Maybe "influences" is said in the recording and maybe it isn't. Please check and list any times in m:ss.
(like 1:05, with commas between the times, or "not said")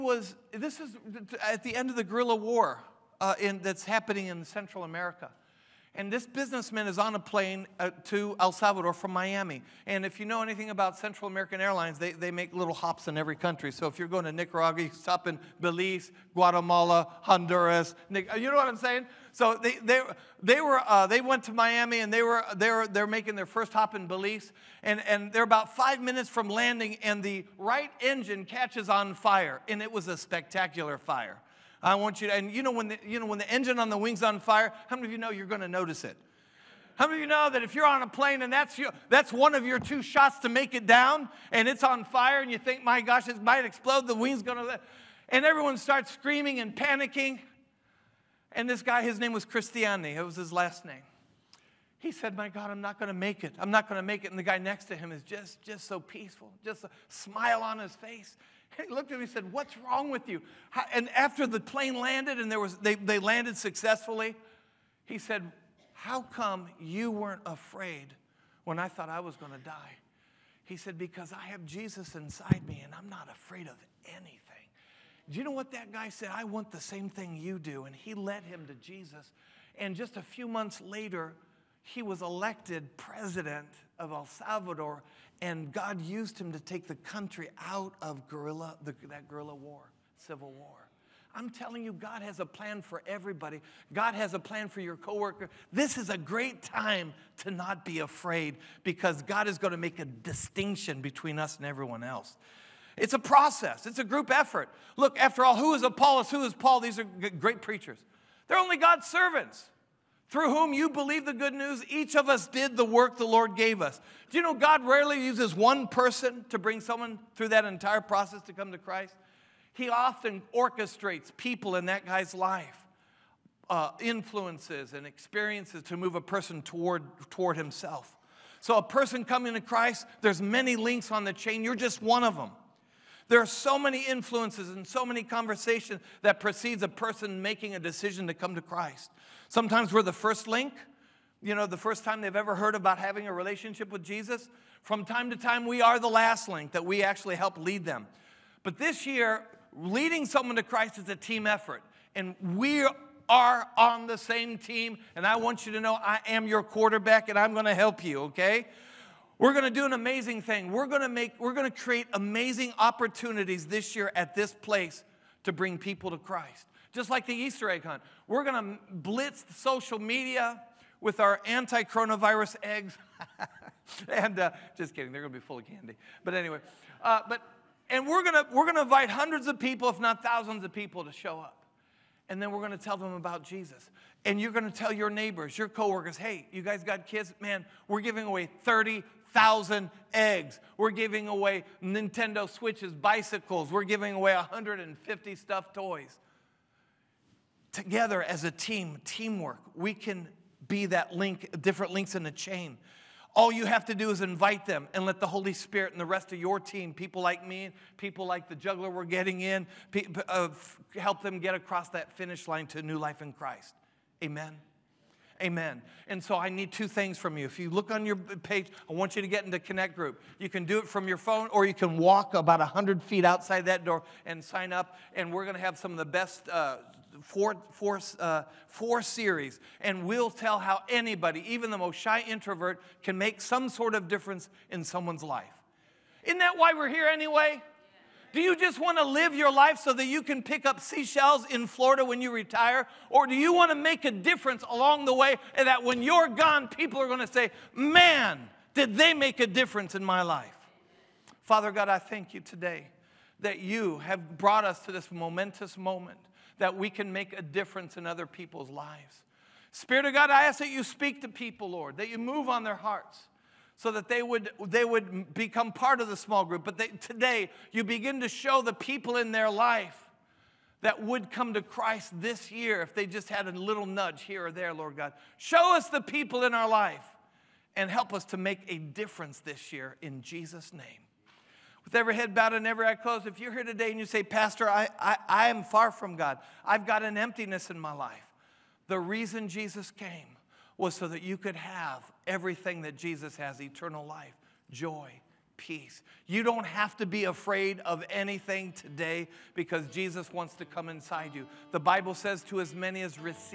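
2:03, 2:14.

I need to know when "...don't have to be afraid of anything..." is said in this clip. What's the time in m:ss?
4:56.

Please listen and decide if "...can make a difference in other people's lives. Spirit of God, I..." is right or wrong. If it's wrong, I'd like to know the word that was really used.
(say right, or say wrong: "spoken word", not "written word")
right.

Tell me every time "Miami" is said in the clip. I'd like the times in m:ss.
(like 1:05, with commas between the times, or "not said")
0:09, 0:21.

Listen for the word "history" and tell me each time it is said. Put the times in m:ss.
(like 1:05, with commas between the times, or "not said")
not said.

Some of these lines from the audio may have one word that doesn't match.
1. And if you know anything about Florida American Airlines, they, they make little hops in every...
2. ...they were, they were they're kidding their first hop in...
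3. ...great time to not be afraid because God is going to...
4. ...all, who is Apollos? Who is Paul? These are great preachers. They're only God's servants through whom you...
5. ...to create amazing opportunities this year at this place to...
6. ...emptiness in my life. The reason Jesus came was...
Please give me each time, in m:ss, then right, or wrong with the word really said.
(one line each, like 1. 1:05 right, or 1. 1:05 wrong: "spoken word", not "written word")
1. 0:09 wrong: "Central", not "Florida"
2. 0:22 wrong: "making", not "kidding"
3. 1:36 right
4. 1:45 right
5. 2:41 right
6. 4:47 right.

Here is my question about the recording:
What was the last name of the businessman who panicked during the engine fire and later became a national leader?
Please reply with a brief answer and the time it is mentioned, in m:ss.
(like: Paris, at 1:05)
Cristiani, at 0:49.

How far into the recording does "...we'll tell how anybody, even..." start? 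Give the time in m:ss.
3:50.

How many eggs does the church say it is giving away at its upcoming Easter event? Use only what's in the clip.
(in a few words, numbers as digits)
30,000.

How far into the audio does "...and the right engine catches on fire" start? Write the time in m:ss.
0:27.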